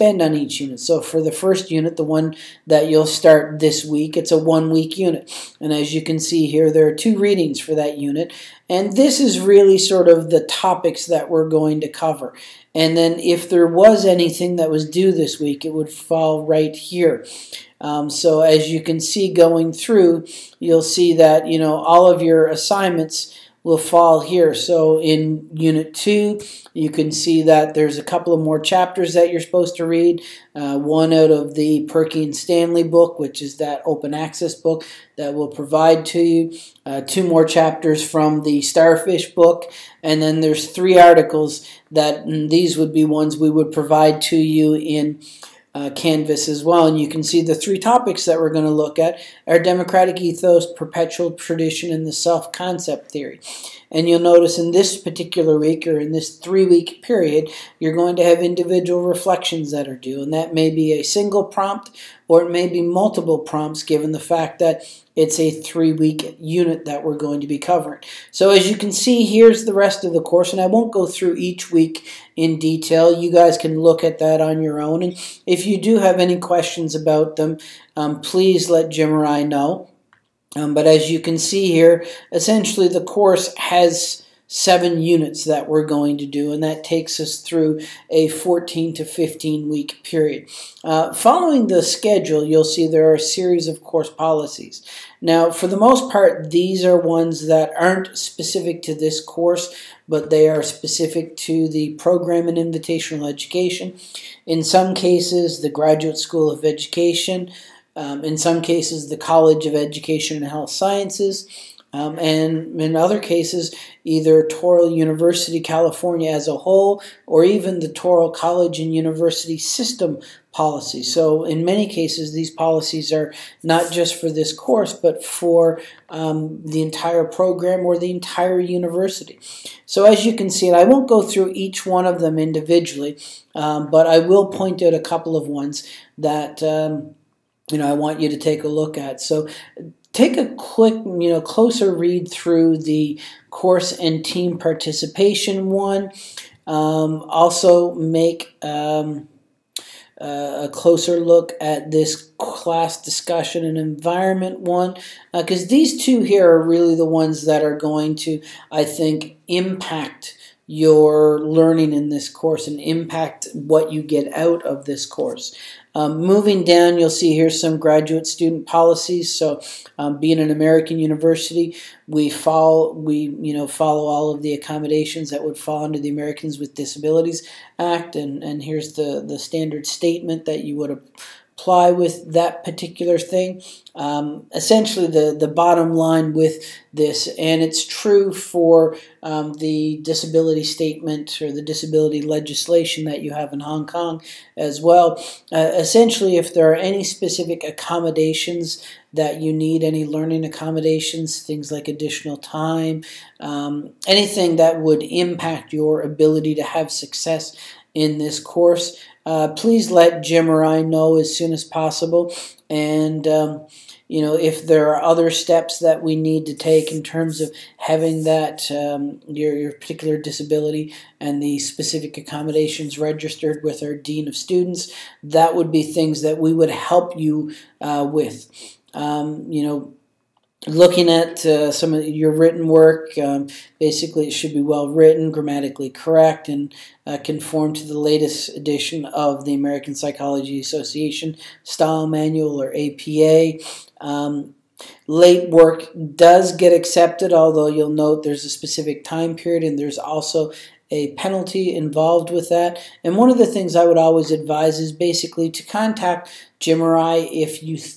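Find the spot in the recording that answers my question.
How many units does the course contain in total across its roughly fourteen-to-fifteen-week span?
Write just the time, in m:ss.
1:24.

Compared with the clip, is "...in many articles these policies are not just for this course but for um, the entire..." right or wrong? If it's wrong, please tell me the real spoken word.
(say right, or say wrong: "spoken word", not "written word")
wrong: "cases", not "articles".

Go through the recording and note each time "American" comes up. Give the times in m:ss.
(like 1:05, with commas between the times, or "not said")
2:50, 2:56, 3:59.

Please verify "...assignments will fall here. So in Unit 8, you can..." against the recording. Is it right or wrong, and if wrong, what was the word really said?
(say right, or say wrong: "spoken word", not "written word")
wrong: "2", not "8".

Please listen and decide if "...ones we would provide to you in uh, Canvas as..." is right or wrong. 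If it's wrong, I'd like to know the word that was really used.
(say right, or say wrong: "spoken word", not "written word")
right.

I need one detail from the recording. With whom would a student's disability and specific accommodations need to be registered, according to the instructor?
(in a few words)
Dean of Students.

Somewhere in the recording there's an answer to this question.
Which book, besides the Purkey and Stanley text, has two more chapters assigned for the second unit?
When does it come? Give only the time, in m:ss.
0:38.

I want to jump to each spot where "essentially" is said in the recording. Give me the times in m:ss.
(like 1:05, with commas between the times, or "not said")
1:22, 3:04, 3:15.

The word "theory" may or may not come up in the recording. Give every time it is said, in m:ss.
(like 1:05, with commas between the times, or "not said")
0:53.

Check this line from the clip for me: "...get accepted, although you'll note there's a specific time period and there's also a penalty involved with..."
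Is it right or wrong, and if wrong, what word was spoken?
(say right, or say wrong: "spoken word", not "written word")
right.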